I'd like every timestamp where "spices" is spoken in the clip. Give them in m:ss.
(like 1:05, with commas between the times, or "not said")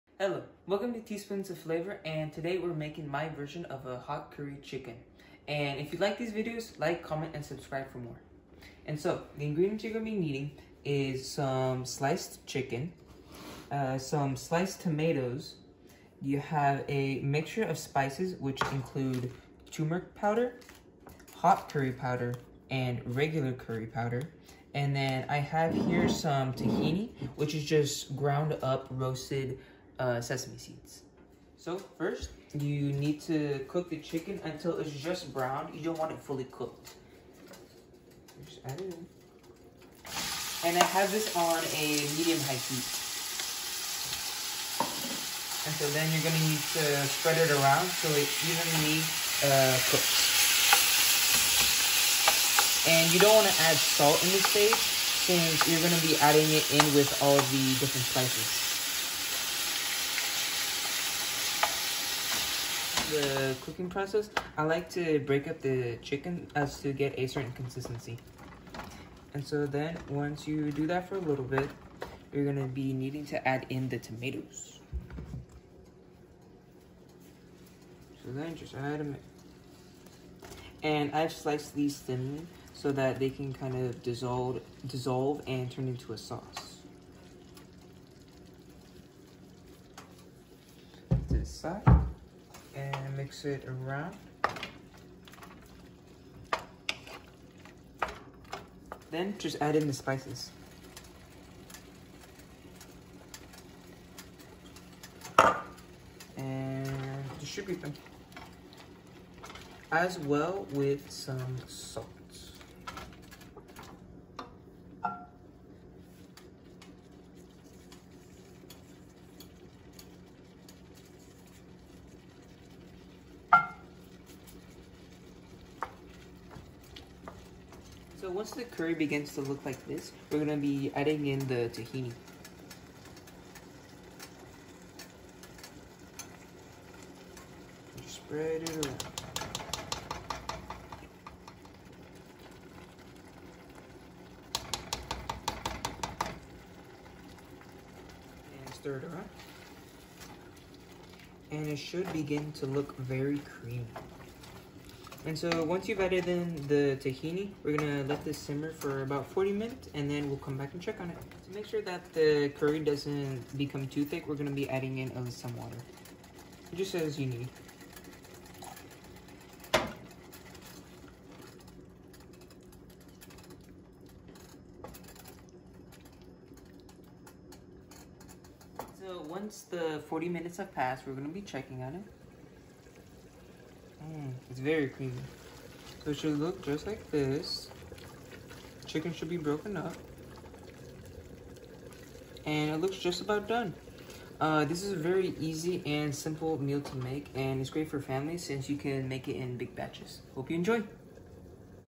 0:17, 0:58, 1:39.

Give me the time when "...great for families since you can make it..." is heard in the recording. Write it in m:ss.
3:17.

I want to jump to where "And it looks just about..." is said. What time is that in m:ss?
3:12.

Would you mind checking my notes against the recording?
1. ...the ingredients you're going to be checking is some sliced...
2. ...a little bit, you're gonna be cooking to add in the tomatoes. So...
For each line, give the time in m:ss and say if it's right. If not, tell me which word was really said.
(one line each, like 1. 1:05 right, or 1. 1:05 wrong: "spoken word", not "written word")
1. 0:09 wrong: "needing", not "checking"
2. 1:11 wrong: "needing", not "cooking".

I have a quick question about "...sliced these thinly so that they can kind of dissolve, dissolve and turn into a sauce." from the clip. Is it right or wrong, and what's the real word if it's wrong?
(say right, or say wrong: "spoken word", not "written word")
right.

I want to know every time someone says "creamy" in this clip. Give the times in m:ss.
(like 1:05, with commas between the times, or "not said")
2:33, 3:04.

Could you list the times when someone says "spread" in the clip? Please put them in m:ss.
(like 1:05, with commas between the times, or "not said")
0:47, 2:18.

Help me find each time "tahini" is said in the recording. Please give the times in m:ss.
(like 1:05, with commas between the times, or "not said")
0:26, 2:11, 2:36.